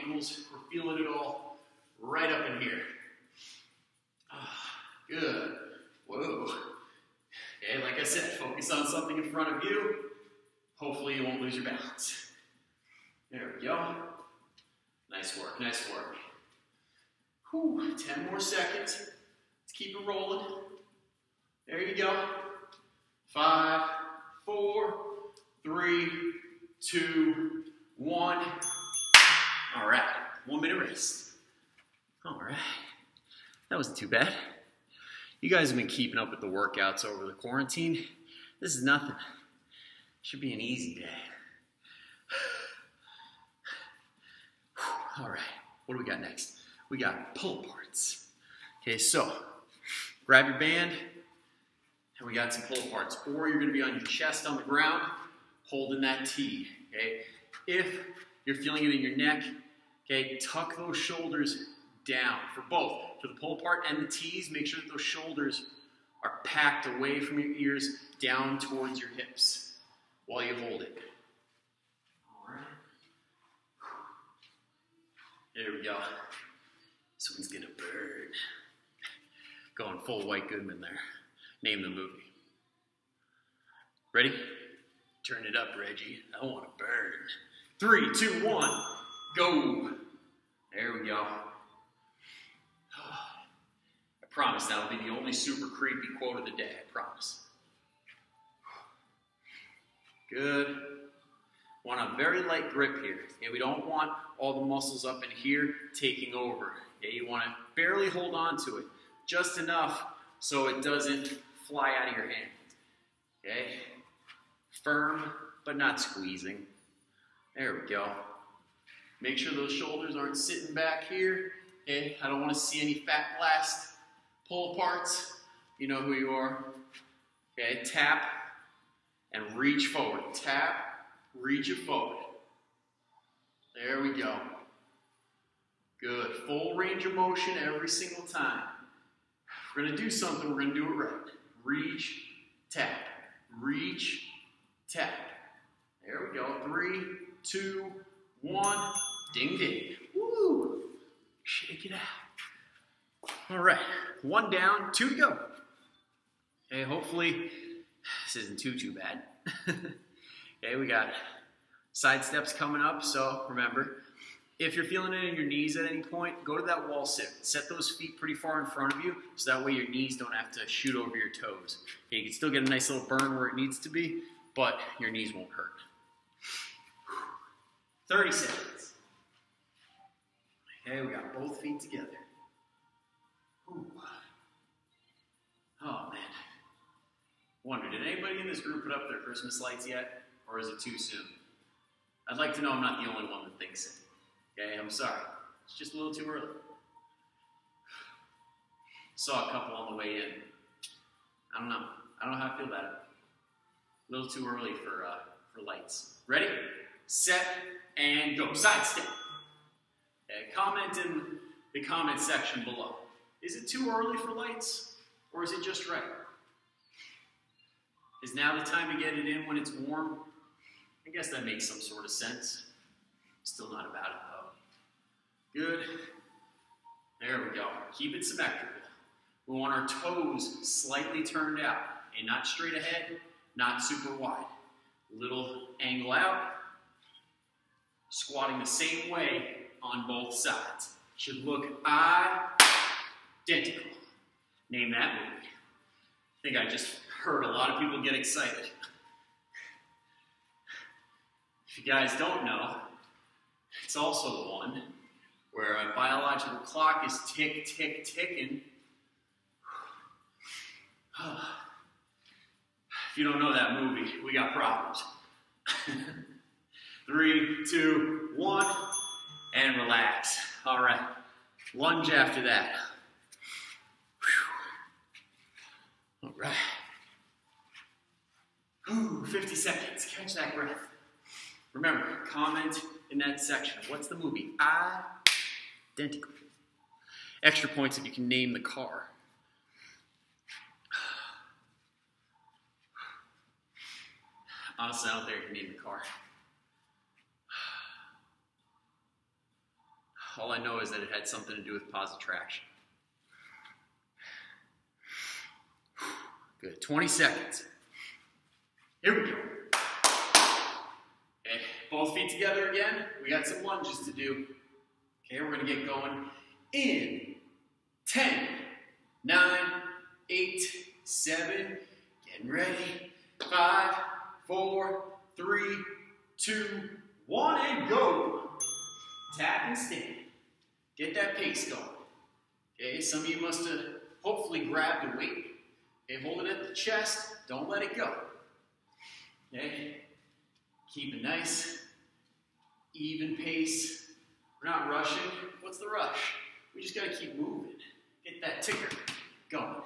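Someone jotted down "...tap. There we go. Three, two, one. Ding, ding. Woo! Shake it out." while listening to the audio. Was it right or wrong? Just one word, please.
right.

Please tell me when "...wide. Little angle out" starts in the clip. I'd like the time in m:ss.
3:54.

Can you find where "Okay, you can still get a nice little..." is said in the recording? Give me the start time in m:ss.
2:52.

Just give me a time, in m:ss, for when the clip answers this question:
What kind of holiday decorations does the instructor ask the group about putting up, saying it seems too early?
3:09.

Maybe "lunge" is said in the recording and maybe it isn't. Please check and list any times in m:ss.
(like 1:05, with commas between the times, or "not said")
4:31, 5:13.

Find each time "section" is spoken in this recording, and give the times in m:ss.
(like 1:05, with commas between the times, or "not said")
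3:32, 4:43.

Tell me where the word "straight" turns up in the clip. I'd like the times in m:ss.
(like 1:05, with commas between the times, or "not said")
3:52.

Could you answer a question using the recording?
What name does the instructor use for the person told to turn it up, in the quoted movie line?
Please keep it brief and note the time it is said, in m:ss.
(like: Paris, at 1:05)
Reggie, at 1:25.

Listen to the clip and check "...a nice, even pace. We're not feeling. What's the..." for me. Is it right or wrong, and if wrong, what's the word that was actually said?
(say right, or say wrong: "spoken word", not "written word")
wrong: "rushing", not "feeling".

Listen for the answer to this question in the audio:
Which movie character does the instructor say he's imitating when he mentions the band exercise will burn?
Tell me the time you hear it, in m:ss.
1:20.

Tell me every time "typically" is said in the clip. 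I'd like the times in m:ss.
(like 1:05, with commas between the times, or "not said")
not said.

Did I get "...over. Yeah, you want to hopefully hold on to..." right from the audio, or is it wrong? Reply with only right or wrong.
wrong.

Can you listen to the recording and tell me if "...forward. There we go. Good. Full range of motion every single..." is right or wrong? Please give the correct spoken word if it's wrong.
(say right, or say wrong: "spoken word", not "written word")
right.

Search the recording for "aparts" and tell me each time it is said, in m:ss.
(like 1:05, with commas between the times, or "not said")
0:52, 1:03, 2:04.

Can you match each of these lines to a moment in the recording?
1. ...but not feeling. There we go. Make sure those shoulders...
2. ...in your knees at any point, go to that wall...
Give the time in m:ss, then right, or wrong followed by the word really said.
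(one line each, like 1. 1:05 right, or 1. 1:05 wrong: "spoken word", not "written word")
1. 1:55 wrong: "squeezing", not "feeling"
2. 2:45 right.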